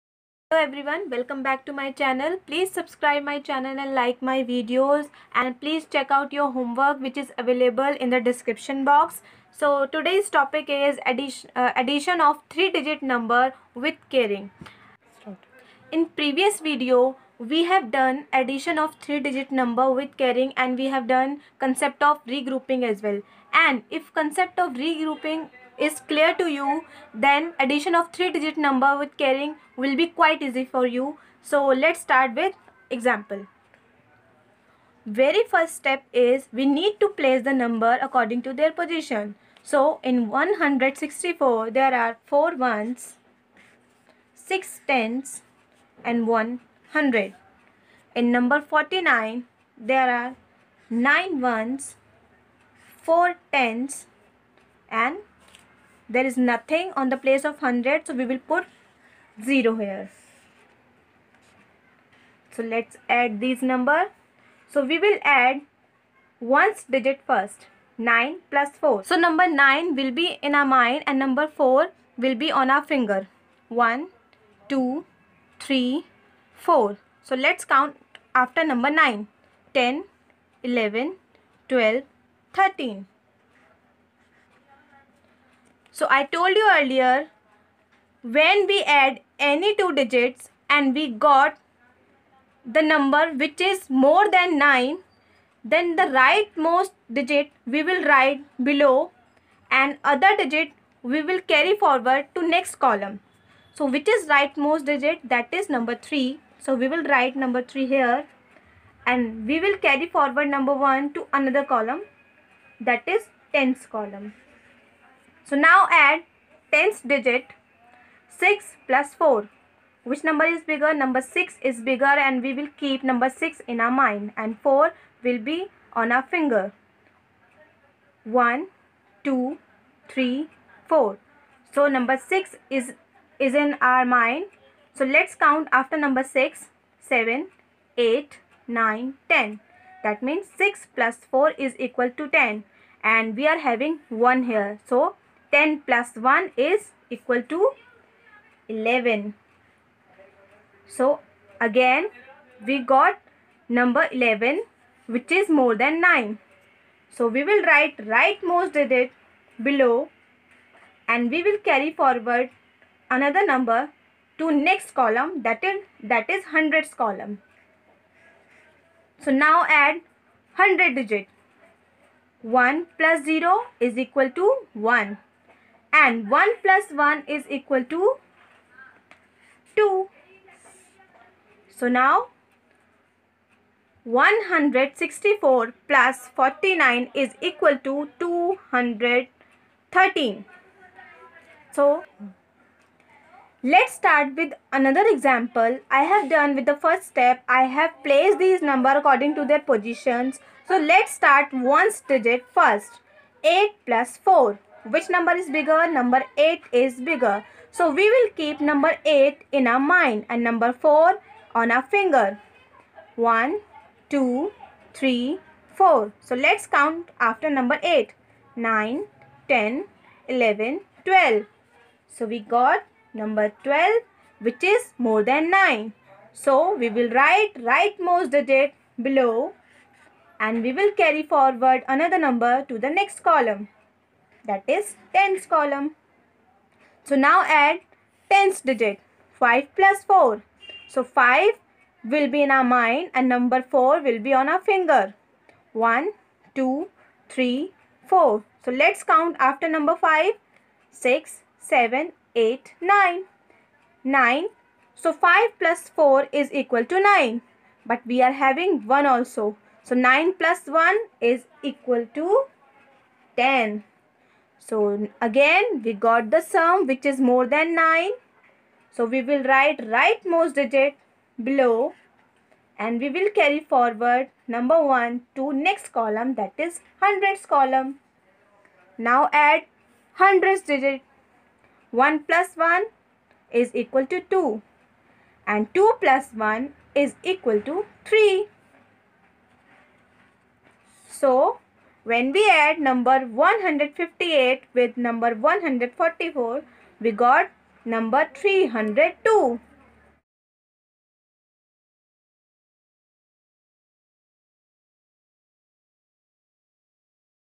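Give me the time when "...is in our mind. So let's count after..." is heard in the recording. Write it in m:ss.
2:13.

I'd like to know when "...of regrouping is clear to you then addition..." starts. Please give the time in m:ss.
0:24.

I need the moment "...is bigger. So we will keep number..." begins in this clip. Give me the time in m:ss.
3:26.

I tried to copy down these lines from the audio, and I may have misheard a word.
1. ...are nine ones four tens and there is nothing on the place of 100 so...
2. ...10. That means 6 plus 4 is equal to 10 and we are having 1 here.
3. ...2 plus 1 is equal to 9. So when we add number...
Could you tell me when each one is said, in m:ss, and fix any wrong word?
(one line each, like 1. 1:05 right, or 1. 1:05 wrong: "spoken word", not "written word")
1. 0:50 right
2. 2:19 right
3. 4:45 wrong: "3", not "9".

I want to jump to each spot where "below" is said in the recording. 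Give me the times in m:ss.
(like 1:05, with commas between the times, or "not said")
1:38, 2:39, 3:49, 4:31.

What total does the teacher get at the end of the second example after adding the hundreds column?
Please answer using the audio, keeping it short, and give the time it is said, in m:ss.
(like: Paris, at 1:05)
302, at 4:58.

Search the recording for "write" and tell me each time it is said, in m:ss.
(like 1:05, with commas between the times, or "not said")
1:38, 1:47, 2:37, 3:47, 4:29.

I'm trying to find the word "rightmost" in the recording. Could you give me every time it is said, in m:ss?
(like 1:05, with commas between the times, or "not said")
1:36, 1:44, 2:38, 3:47, 4:29.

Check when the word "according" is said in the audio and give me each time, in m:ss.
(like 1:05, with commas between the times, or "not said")
0:38, 3:18.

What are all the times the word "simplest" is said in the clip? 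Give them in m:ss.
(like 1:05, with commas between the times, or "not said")
not said.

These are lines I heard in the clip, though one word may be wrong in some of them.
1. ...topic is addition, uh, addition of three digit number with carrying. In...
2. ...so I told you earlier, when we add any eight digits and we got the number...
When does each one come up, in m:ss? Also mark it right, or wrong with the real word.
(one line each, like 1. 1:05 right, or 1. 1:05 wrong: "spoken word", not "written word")
1. 0:10 right
2. 1:26 wrong: "two", not "eight".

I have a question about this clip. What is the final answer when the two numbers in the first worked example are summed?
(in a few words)
213.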